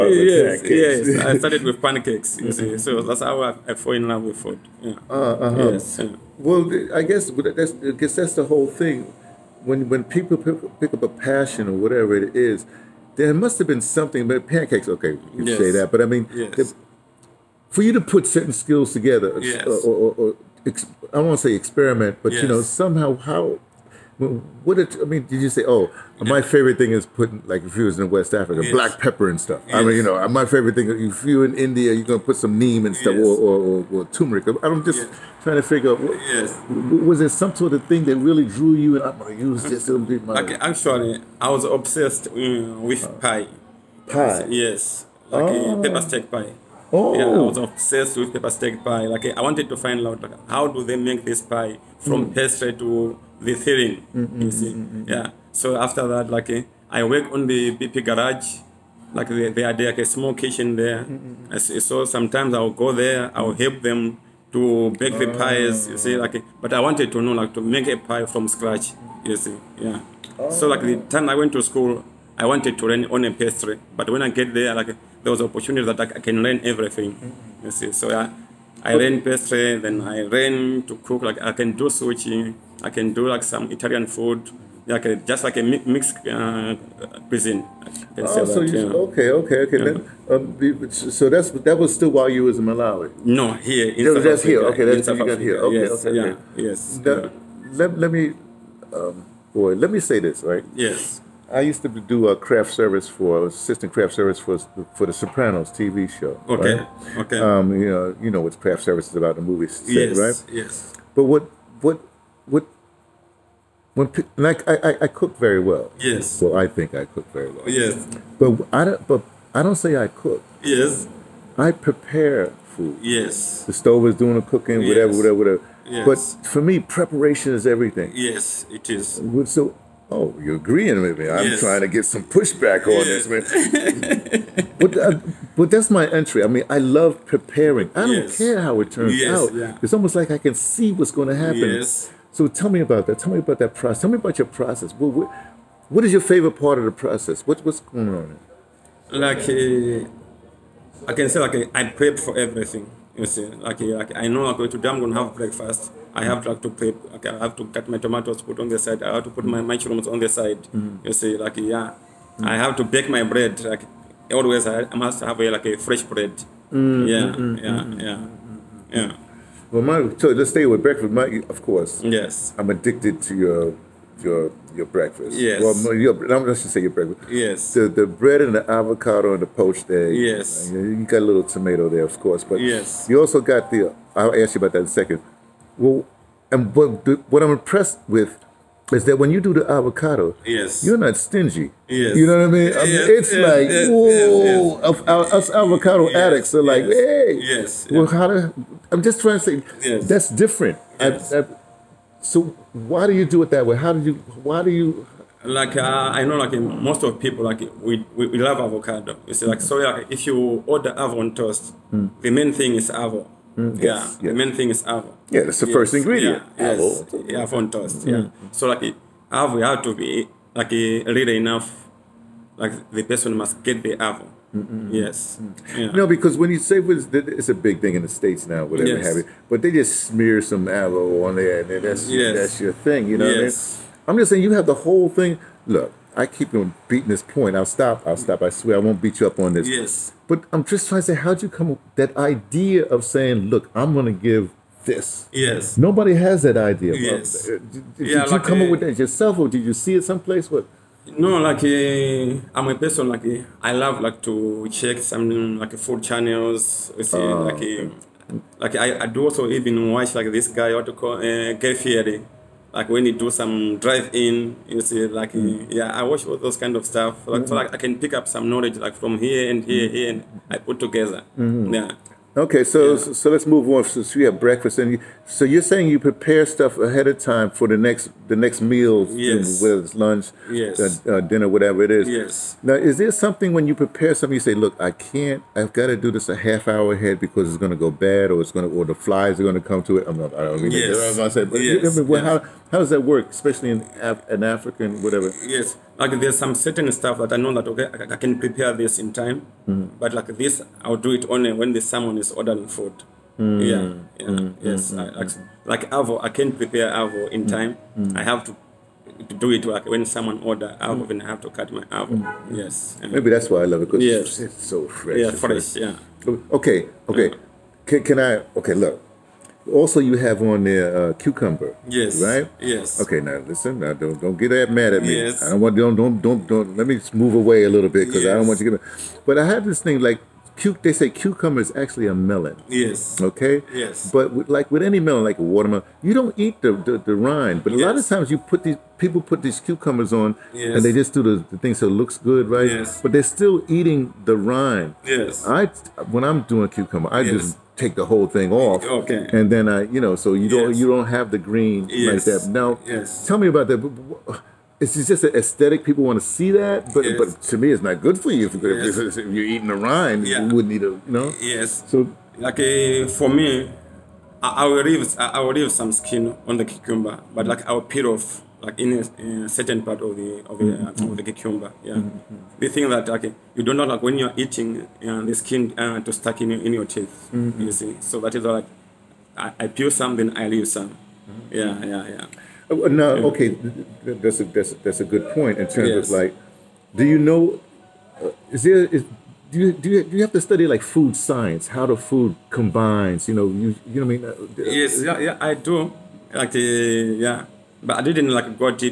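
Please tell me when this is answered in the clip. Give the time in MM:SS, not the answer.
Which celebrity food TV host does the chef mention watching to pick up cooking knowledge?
04:21.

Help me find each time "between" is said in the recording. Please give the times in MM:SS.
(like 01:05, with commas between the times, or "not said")
not said.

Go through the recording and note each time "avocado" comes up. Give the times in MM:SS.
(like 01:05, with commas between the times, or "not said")
02:58, 03:09, 03:15, 03:28, 03:50.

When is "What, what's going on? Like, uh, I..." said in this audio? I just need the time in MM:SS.
02:27.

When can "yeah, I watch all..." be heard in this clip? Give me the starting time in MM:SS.
04:25.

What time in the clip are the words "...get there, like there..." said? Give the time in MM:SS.
01:14.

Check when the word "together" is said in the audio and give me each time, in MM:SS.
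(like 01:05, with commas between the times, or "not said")
00:18, 04:30.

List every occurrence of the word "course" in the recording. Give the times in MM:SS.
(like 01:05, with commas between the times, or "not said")
02:51, 03:02.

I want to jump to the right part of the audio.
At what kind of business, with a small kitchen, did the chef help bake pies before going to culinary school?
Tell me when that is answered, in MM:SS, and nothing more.
00:57.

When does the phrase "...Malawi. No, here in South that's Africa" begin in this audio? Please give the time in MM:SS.
01:32.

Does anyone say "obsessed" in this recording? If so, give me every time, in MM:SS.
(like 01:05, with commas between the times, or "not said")
00:41, 00:47.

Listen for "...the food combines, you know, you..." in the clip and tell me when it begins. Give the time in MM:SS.
06:31.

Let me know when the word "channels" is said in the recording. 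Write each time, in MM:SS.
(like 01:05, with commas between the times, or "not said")
04:16.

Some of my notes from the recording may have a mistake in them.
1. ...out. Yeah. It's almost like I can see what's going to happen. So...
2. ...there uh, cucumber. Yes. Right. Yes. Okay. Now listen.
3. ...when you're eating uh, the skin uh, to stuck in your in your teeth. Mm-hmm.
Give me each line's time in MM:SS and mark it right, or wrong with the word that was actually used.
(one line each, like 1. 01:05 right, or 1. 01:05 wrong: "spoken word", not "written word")
1. 02:19 right
2. 05:20 right
3. 06:14 right.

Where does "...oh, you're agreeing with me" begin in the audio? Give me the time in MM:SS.
02:10.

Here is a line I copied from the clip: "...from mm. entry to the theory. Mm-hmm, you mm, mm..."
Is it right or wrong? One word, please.
wrong.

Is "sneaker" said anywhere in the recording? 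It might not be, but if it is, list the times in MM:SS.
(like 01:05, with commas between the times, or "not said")
not said.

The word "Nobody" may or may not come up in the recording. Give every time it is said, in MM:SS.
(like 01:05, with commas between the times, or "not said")
04:05.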